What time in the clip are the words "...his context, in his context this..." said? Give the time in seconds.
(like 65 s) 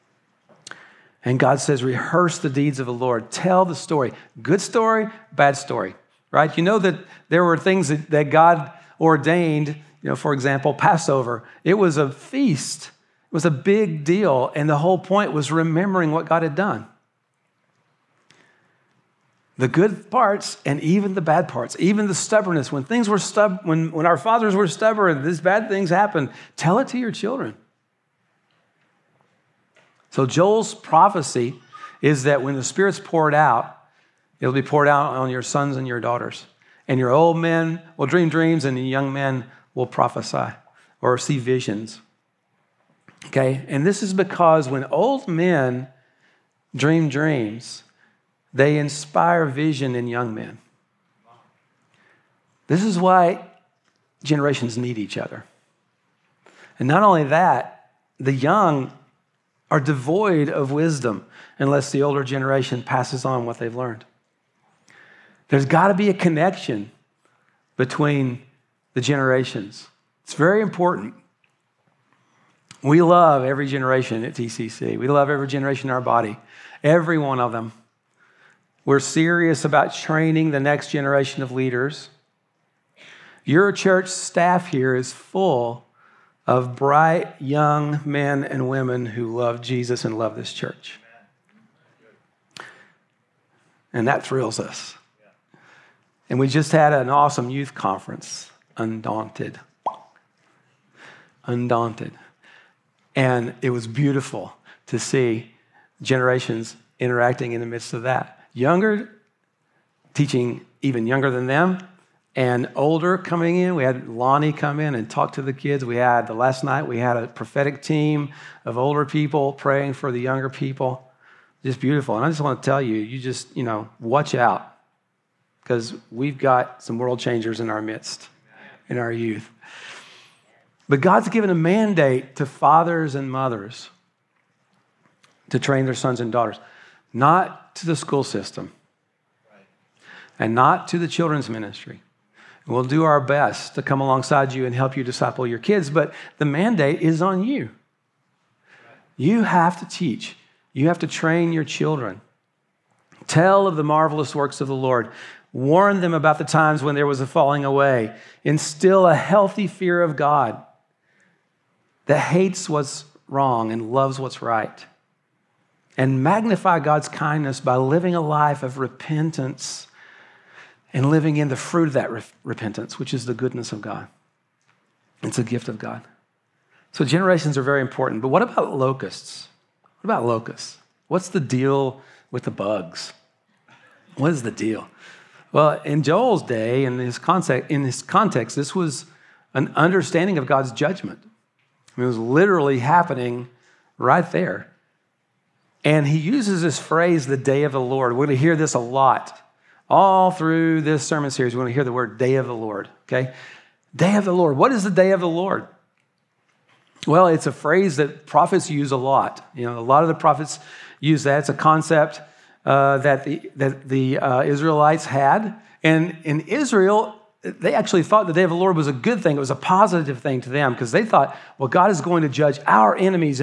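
186 s.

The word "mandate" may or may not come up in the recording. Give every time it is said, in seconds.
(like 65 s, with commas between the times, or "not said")
131 s, 146 s.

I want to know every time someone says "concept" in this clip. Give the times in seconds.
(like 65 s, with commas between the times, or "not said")
211 s.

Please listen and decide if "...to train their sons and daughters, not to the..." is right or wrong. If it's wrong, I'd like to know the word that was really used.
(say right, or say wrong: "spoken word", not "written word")
right.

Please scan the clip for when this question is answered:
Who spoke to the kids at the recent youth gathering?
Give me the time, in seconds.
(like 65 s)
114 s.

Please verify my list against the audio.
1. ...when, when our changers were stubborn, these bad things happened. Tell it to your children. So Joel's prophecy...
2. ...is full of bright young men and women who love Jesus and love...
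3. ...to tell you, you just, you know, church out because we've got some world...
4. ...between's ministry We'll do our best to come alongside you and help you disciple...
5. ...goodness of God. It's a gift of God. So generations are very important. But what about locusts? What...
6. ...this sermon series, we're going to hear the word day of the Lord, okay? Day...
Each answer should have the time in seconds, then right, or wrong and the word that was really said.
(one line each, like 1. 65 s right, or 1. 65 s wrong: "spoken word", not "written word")
1. 23 s wrong: "fathers", not "changers"
2. 84 s right
3. 122 s wrong: "watch", not "church"
4. 141 s wrong: "children", not "between"
5. 173 s right
6. 200 s right.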